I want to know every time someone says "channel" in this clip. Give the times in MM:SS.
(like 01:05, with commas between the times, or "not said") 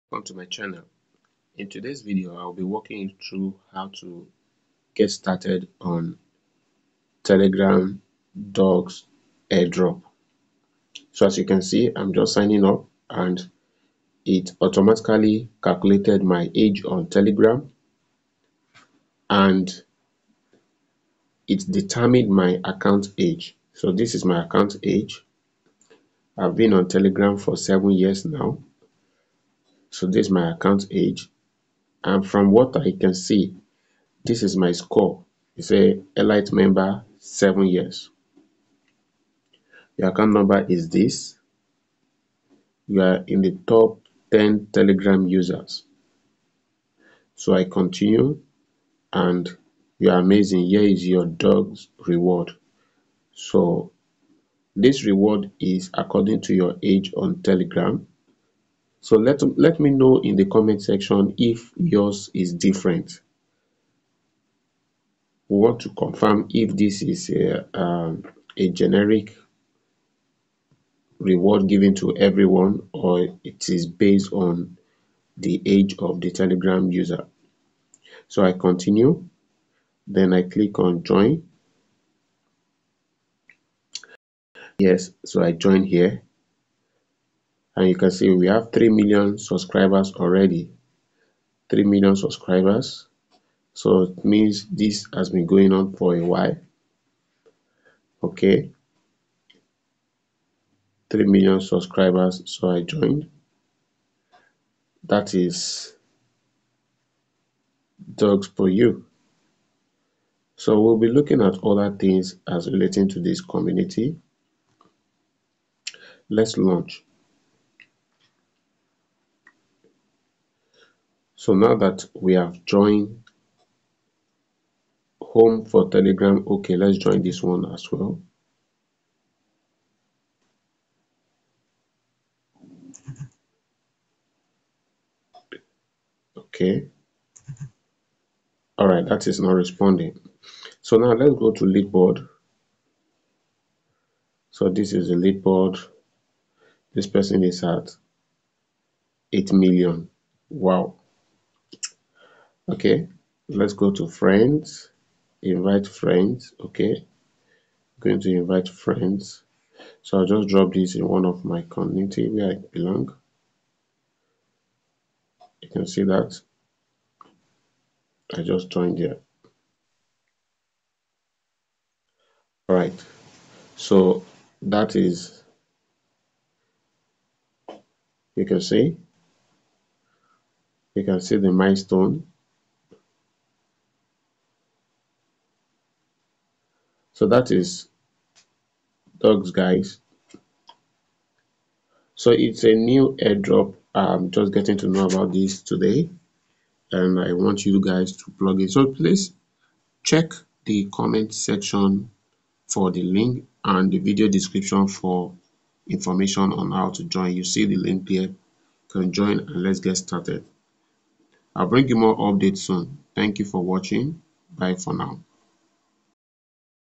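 00:00.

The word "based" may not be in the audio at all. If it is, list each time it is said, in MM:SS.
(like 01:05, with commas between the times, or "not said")
01:13.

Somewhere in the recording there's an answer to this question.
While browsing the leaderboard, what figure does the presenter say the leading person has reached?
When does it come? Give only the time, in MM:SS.
02:29.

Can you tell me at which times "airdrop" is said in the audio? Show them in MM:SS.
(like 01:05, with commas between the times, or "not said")
00:09, 03:13.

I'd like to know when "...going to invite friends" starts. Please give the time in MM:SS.
02:37.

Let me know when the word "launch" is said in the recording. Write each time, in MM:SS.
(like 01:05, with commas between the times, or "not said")
01:56.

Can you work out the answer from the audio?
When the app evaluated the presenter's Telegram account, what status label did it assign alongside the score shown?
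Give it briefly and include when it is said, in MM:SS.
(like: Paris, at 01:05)
Elite member, at 00:36.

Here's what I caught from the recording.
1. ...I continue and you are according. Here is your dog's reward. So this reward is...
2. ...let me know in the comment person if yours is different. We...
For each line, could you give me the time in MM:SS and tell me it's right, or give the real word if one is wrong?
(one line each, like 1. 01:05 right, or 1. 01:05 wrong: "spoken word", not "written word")
1. 00:47 wrong: "amazing", not "according"
2. 00:59 wrong: "section", not "person".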